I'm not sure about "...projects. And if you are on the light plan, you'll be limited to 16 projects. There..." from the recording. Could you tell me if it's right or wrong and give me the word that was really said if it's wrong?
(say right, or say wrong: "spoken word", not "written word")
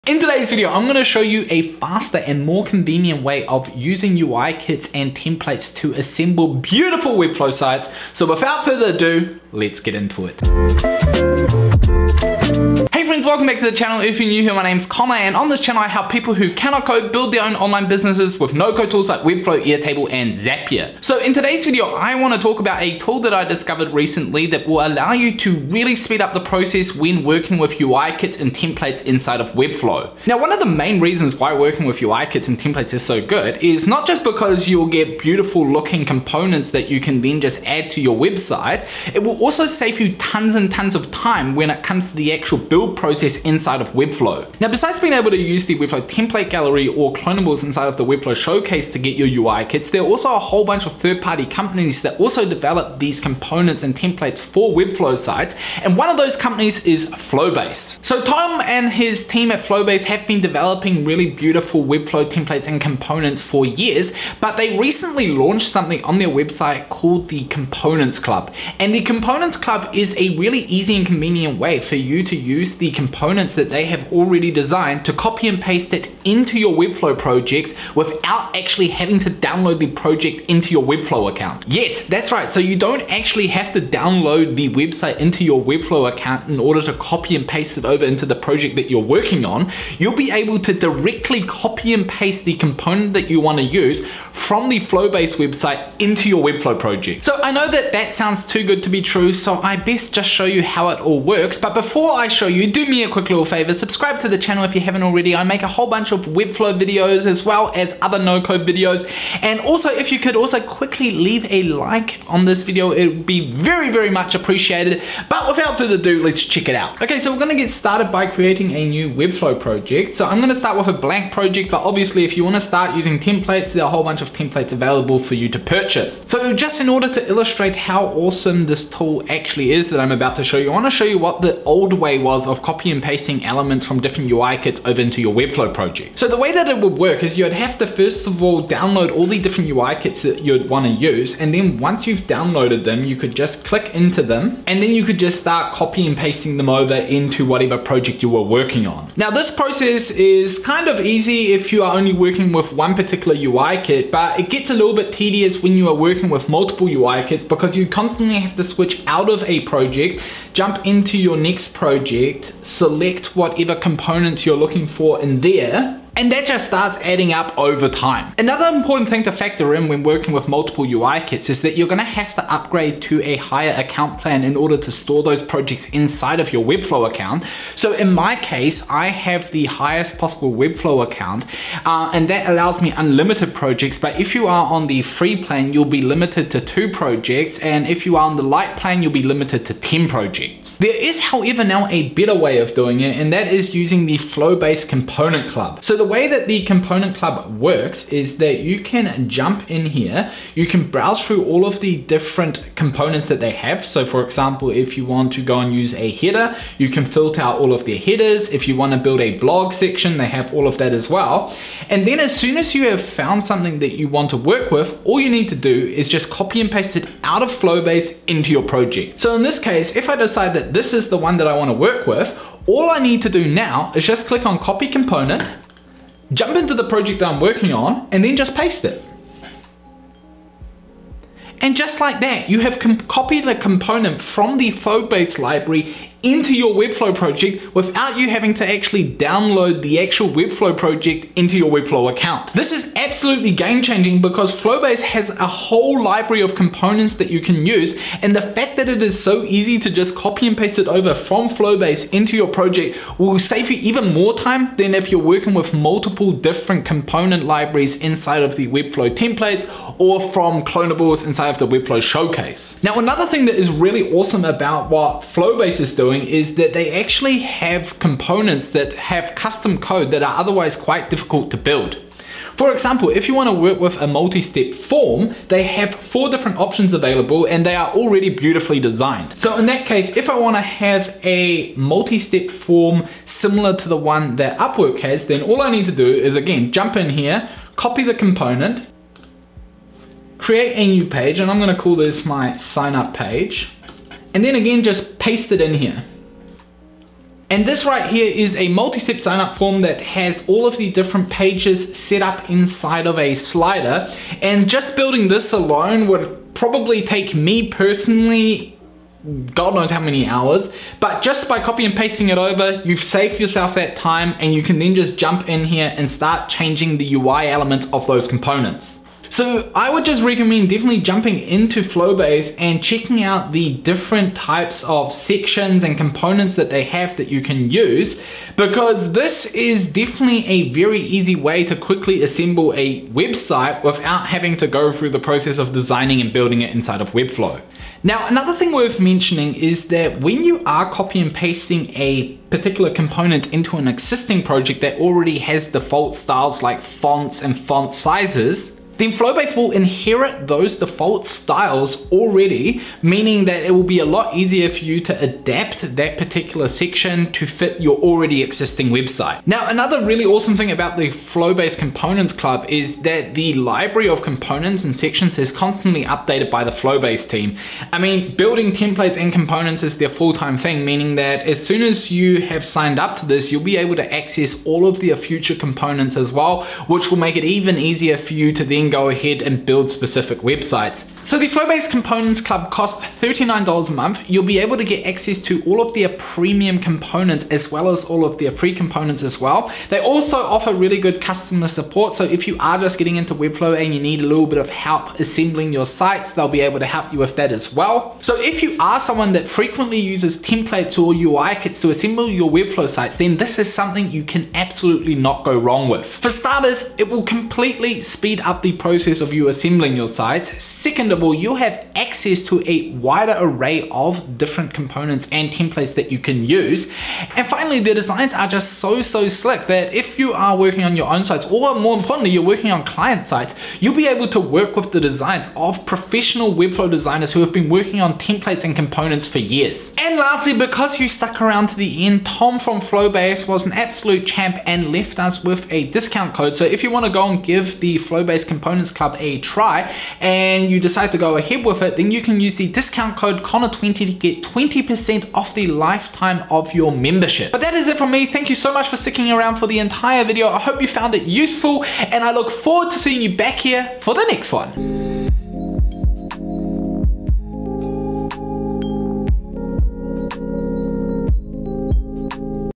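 wrong: "10", not "16".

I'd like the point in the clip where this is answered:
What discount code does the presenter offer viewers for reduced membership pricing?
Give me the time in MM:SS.
07:23.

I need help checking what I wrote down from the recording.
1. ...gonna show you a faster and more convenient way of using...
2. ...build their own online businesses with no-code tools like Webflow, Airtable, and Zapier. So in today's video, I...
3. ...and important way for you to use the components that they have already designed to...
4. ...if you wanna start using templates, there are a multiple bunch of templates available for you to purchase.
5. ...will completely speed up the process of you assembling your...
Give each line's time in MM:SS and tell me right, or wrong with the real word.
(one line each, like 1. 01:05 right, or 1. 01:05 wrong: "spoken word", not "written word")
1. 00:00 right
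2. 00:17 right
3. 01:10 wrong: "convenient", not "important"
4. 02:02 wrong: "whole", not "multiple"
5. 06:47 right.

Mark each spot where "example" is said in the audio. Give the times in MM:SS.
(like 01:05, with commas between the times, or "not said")
03:24, 04:32.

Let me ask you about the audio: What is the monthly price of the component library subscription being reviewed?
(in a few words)
$39.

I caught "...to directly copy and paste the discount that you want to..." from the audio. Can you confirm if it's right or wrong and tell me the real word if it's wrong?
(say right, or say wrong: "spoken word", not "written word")
wrong: "component", not "discount".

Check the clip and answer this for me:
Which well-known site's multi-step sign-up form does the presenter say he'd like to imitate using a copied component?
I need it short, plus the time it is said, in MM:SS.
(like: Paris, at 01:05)
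Upwork, at 04:44.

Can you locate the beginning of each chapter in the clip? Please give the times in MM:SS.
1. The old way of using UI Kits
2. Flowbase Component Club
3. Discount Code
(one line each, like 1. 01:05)
1. 02:00
2. 03:10
3. 07:10.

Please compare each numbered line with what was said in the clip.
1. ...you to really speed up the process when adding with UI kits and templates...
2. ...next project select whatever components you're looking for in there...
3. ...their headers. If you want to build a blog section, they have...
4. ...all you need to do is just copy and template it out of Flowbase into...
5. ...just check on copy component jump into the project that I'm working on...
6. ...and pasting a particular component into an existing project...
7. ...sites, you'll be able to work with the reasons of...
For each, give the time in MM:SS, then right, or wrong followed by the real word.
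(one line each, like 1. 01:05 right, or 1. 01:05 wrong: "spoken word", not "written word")
1. 00:25 wrong: "working", not "adding"
2. 02:41 right
3. 03:27 right
4. 03:35 wrong: "paste", not "template"
5. 03:44 wrong: "click", not "check"
6. 05:41 right
7. 07:03 wrong: "designs", not "reasons".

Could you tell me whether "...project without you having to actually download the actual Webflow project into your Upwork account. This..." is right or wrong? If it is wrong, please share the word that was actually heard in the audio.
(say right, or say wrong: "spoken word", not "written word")
wrong: "Webflow", not "Upwork".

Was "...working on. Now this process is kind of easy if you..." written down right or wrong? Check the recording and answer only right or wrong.
right.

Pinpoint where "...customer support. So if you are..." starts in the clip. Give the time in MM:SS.
06:31.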